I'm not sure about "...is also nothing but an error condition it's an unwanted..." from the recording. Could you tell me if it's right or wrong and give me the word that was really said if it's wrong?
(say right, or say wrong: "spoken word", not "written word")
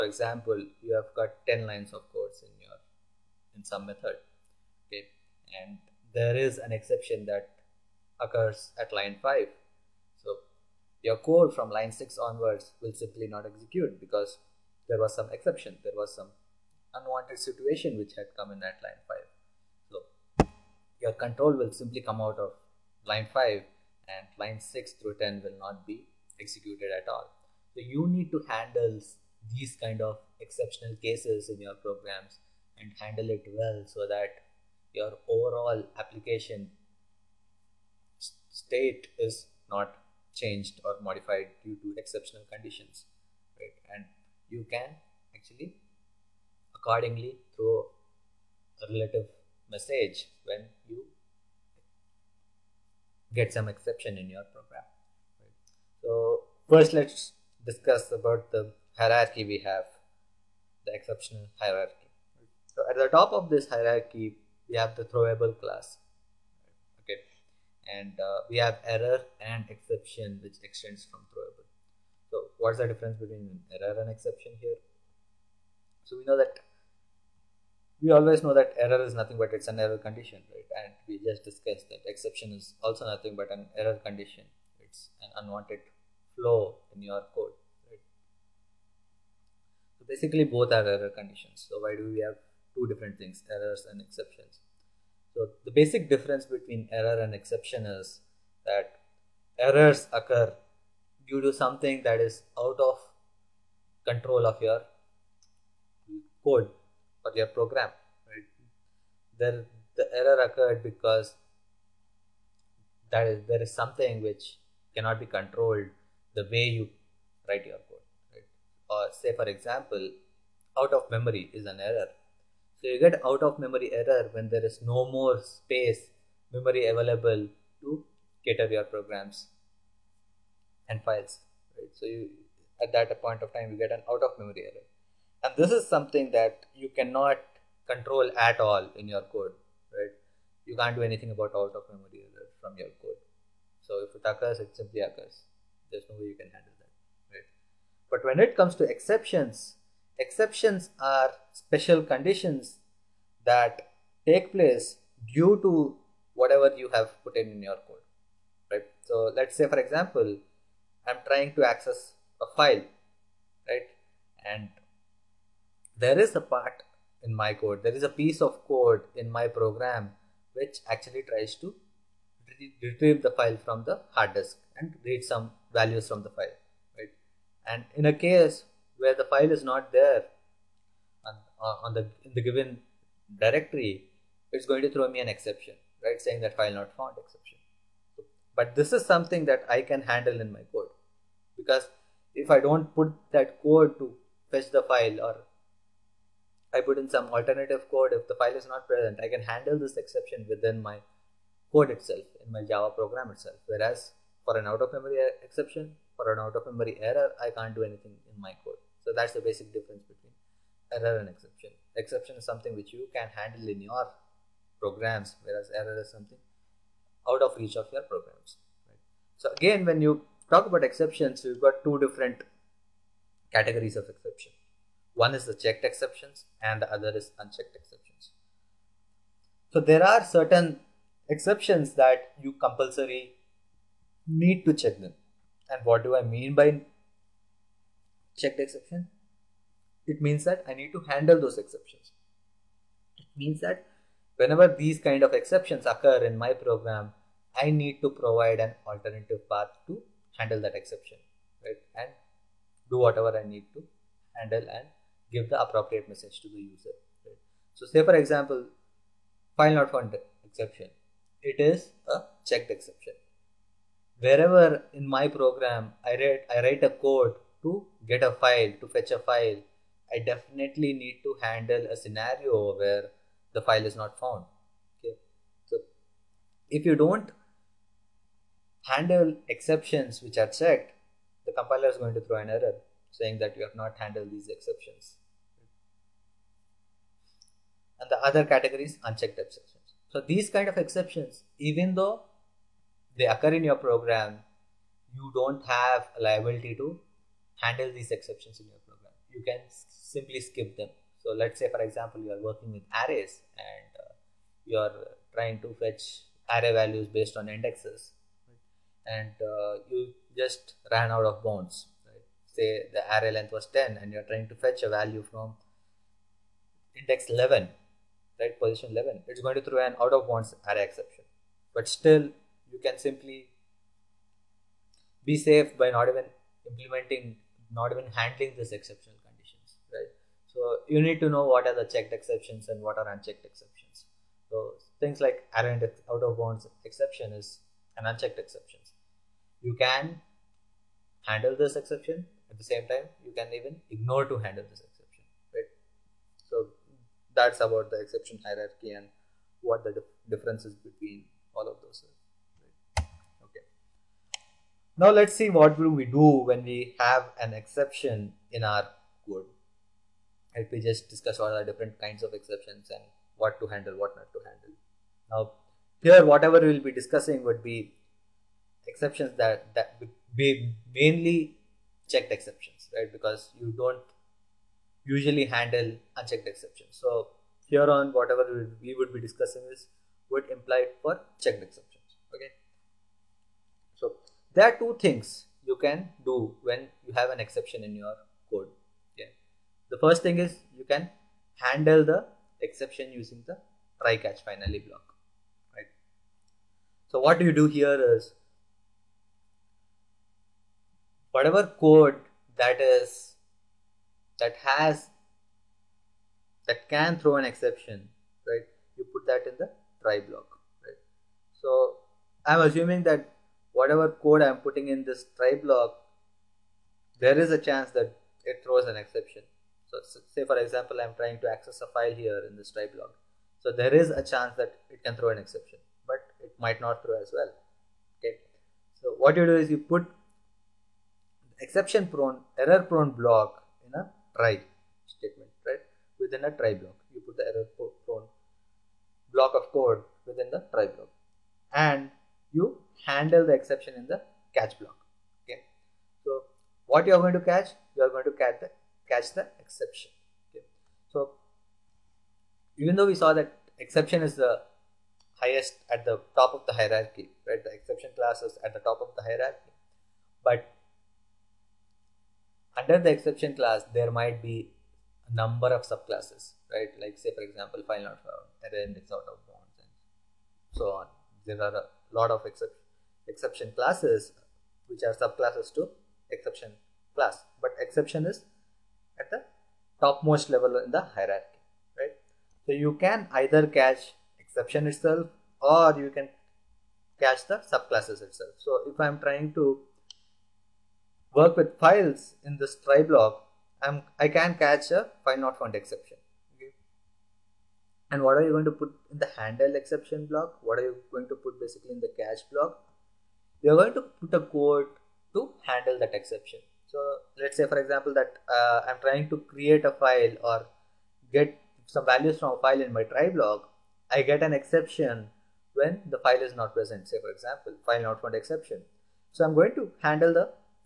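right.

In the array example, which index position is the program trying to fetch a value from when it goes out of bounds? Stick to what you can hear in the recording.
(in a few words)
11.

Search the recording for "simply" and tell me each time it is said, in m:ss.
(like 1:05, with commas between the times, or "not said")
0:12, 0:21, 2:24, 4:59, 5:22.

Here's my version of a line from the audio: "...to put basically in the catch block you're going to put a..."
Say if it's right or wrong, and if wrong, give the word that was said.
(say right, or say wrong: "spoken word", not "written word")
right.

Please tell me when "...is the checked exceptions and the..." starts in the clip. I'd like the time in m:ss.
3:45.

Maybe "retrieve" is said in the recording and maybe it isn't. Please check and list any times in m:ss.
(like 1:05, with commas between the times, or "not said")
2:52.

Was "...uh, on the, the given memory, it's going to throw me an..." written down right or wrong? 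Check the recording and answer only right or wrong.
wrong.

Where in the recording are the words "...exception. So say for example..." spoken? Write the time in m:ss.
6:59.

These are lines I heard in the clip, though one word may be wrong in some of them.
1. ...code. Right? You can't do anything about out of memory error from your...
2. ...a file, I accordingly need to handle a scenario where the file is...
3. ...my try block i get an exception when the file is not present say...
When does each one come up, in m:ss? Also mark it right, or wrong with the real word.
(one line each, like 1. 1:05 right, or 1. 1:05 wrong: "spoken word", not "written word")
1. 2:19 right
2. 4:29 wrong: "definitely", not "accordingly"
3. 8:32 right.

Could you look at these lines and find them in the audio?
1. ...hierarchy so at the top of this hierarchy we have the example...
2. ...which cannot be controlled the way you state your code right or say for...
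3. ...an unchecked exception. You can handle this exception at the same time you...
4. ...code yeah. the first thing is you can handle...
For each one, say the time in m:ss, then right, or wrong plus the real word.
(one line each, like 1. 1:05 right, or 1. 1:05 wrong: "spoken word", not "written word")
1. 1:01 wrong: "throwable", not "example"
2. 1:54 wrong: "write", not "state"
3. 5:37 right
4. 6:28 right.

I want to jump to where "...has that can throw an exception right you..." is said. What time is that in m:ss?
6:44.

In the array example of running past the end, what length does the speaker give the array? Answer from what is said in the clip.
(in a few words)
10.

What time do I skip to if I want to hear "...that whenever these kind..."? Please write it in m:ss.
4:03.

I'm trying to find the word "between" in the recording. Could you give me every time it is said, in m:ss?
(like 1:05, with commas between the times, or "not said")
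1:13, 1:36, 3:30, 5:50.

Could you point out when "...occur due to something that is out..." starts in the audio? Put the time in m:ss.
1:40.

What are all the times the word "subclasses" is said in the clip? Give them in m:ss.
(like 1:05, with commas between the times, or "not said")
7:45, 7:55, 8:07.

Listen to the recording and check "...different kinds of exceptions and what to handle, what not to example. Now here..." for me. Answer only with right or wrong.
wrong.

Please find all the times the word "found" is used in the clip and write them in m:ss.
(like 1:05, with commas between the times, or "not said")
3:06, 4:19, 4:34, 7:48, 8:15, 8:38.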